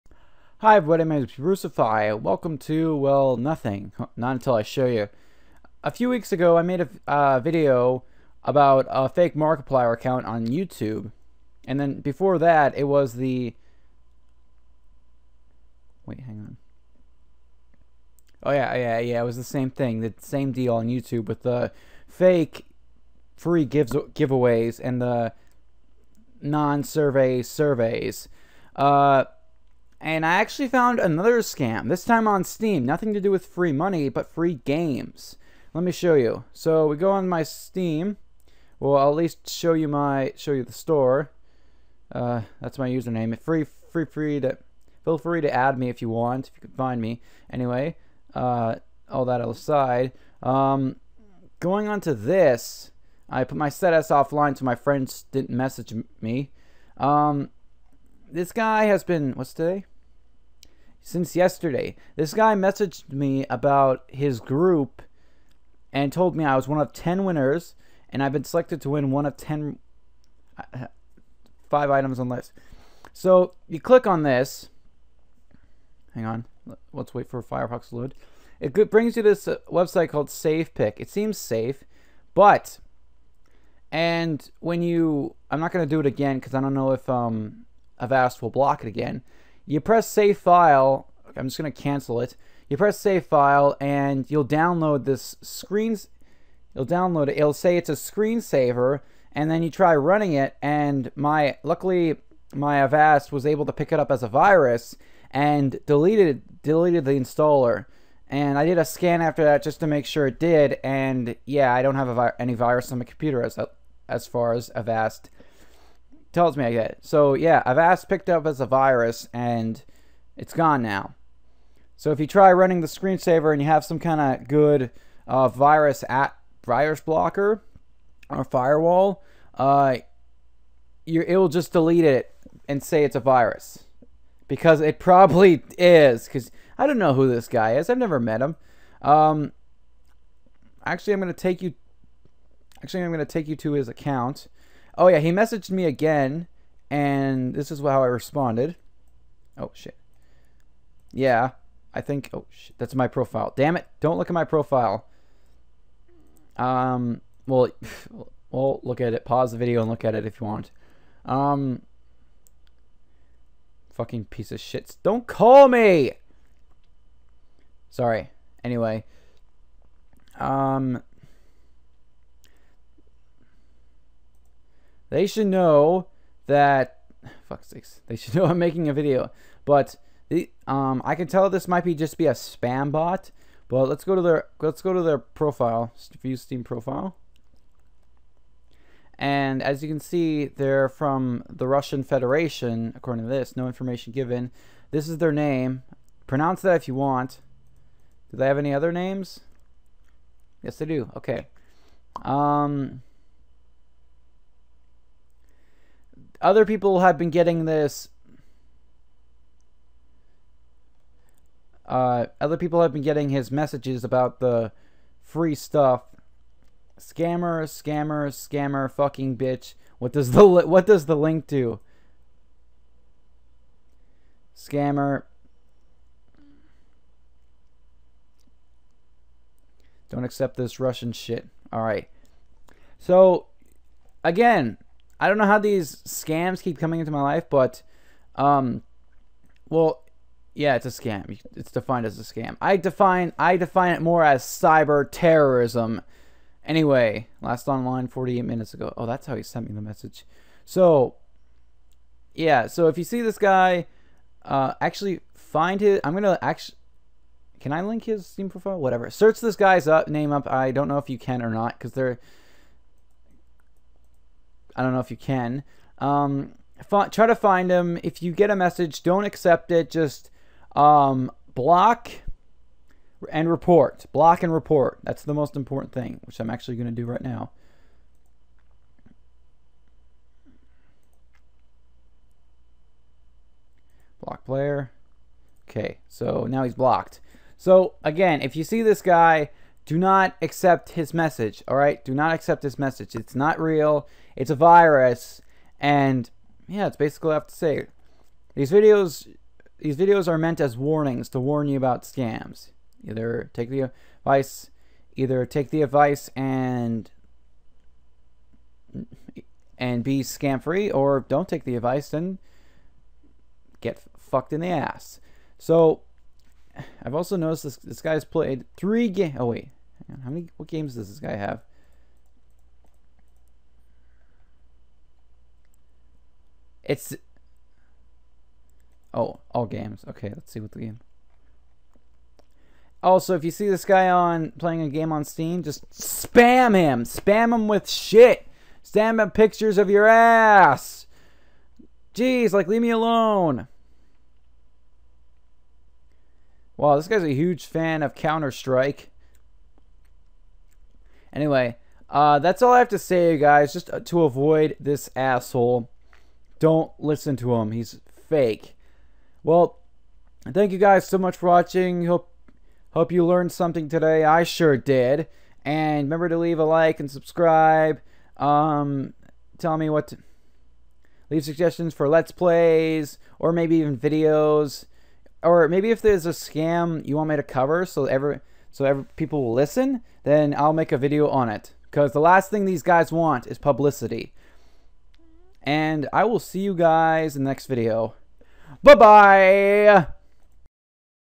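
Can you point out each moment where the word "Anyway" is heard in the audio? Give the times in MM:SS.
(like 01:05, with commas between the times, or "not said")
00:47, 02:48, 04:06, 05:51.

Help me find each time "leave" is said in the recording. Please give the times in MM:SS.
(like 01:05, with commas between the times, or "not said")
05:42, 06:06, 06:11.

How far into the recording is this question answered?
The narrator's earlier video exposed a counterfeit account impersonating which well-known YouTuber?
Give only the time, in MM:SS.
00:09.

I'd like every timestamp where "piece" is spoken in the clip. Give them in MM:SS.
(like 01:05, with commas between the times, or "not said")
02:44.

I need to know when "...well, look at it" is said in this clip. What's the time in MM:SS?
02:38.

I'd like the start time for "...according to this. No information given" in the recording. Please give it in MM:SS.
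03:12.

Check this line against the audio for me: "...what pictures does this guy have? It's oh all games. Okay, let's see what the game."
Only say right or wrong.
wrong.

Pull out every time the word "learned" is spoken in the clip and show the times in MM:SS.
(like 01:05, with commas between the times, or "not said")
06:03.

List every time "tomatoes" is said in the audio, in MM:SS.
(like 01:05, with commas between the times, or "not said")
not said.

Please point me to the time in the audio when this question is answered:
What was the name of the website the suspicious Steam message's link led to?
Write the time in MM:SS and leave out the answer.
01:20.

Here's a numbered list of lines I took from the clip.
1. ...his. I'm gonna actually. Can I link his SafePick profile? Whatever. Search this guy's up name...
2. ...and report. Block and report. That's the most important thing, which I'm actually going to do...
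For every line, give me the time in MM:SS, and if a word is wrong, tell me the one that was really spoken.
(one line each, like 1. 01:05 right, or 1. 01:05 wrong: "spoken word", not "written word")
1. 04:15 wrong: "Steam", not "SafePick"
2. 04:33 right.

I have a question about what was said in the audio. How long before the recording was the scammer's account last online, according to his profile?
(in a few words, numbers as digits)
48 minutes.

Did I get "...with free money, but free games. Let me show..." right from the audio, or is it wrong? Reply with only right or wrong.
right.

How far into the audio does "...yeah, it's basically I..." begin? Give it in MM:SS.
04:56.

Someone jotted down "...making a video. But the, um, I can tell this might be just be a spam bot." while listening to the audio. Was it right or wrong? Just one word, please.
right.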